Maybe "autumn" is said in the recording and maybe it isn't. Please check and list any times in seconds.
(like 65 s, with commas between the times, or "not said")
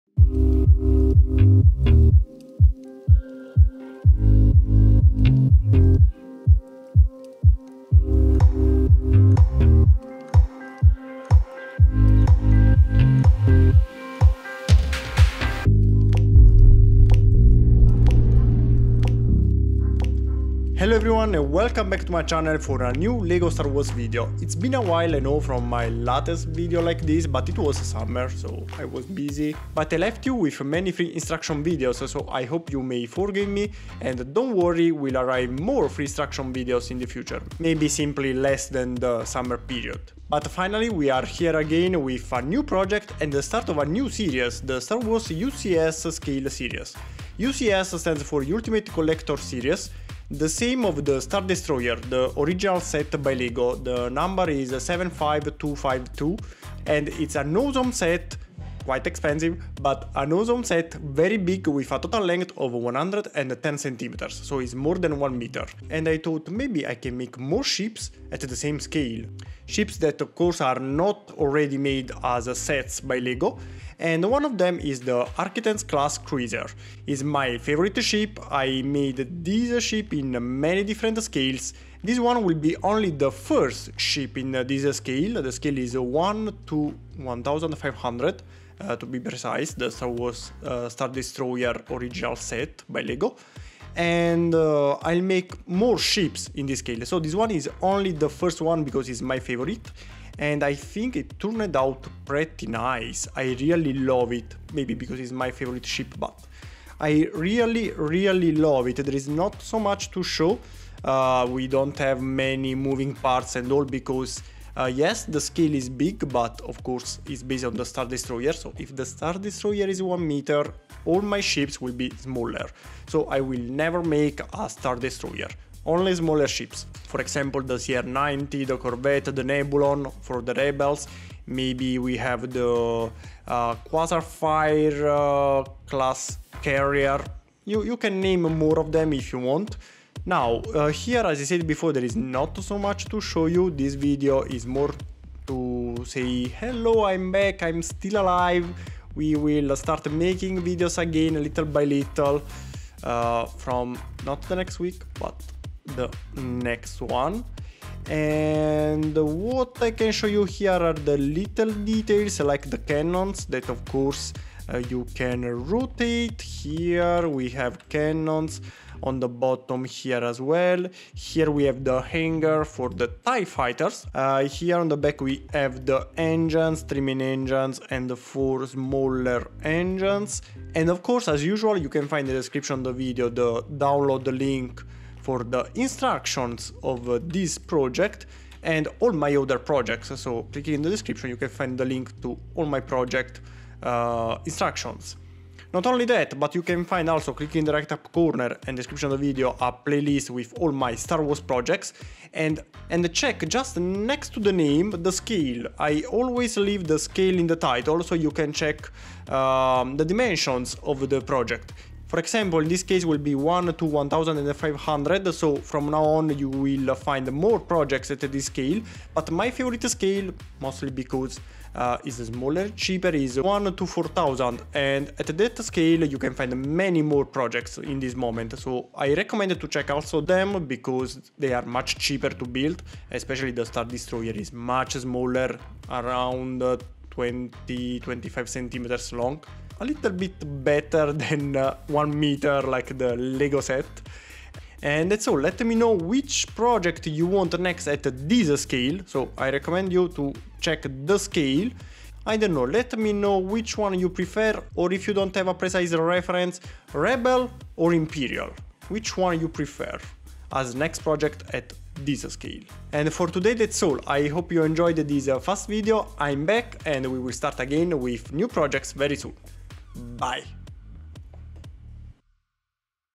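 not said.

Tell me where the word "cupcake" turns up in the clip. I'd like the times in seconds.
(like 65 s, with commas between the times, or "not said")
not said.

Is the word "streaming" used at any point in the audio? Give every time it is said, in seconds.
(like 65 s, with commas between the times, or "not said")
176 s.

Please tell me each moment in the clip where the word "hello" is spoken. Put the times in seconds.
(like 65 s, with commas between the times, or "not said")
20 s, 146 s.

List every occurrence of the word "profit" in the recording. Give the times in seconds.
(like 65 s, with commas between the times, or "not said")
not said.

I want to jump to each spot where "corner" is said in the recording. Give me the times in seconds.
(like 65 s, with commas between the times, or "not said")
198 s.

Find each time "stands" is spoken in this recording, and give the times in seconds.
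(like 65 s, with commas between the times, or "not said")
47 s.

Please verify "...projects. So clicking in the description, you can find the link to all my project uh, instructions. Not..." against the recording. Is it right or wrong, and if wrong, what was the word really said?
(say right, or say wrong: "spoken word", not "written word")
right.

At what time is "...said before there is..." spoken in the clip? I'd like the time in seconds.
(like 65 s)
141 s.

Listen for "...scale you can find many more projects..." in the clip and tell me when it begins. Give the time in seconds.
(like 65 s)
225 s.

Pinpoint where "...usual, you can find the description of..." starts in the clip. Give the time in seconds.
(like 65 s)
181 s.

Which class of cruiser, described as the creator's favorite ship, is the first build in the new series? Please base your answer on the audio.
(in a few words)
Arquitens class cruiser.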